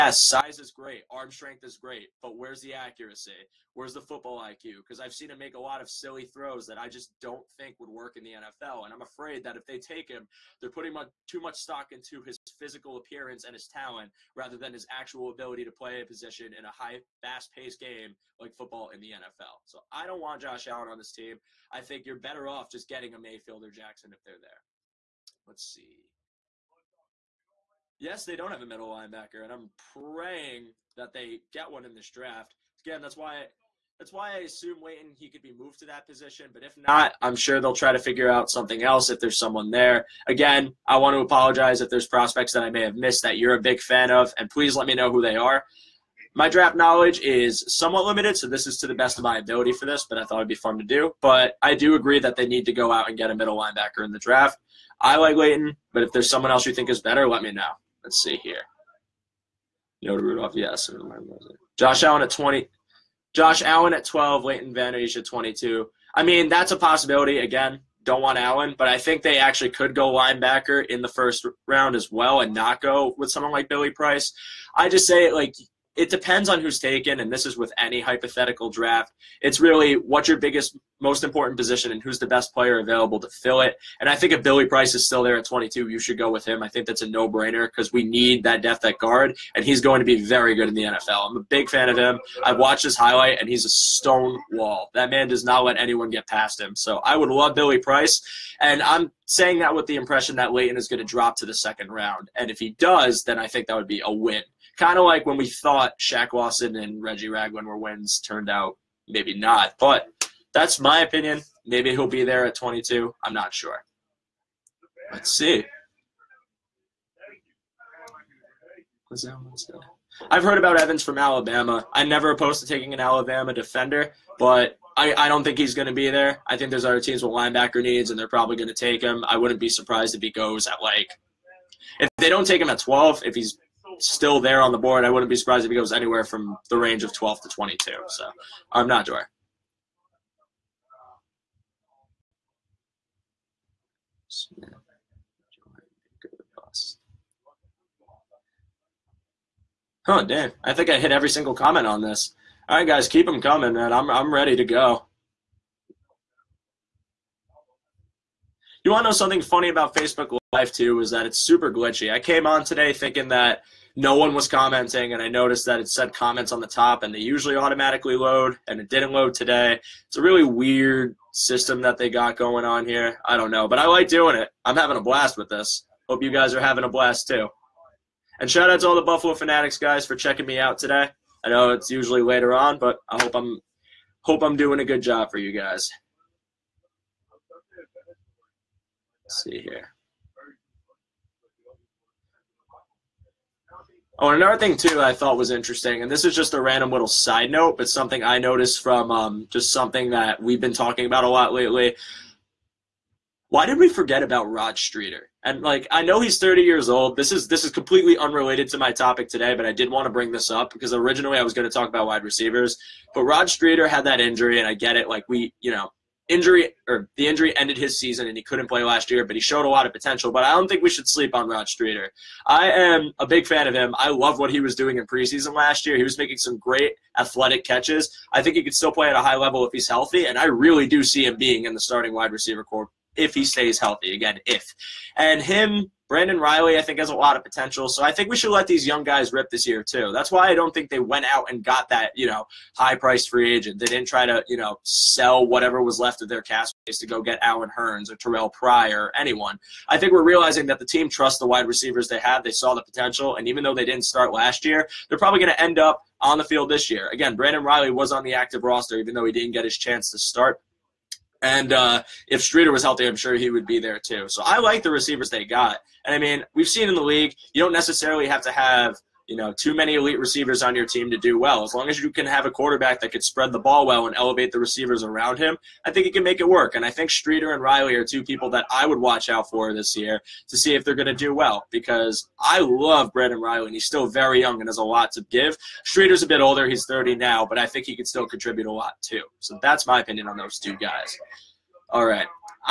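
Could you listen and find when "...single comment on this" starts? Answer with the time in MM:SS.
02:31.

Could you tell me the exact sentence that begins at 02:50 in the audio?
It's a really weird system that they got going on here.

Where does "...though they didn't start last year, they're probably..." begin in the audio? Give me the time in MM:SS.
04:13.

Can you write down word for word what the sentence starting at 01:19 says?
It's really what's your biggest, most important position, and who's the best player available to fill it.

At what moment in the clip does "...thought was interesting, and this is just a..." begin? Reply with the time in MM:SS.
03:15.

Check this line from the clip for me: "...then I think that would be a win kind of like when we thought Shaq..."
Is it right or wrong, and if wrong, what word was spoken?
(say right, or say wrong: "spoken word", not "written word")
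right.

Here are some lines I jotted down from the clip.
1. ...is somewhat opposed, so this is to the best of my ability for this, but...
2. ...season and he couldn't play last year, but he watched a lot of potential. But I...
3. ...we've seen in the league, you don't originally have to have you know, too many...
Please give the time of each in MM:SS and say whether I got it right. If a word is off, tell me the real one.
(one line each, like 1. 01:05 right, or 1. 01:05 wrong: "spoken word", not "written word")
1. 00:47 wrong: "limited", not "opposed"
2. 03:37 wrong: "showed", not "watched"
3. 04:26 wrong: "necessarily", not "originally".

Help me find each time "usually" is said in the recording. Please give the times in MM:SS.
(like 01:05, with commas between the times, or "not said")
02:47, 03:01.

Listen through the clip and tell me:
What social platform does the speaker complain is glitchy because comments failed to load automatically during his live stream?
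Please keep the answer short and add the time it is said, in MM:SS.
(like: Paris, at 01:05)
Facebook, at 02:39.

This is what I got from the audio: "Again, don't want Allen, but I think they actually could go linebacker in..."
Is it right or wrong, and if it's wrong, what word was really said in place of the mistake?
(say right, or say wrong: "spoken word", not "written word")
right.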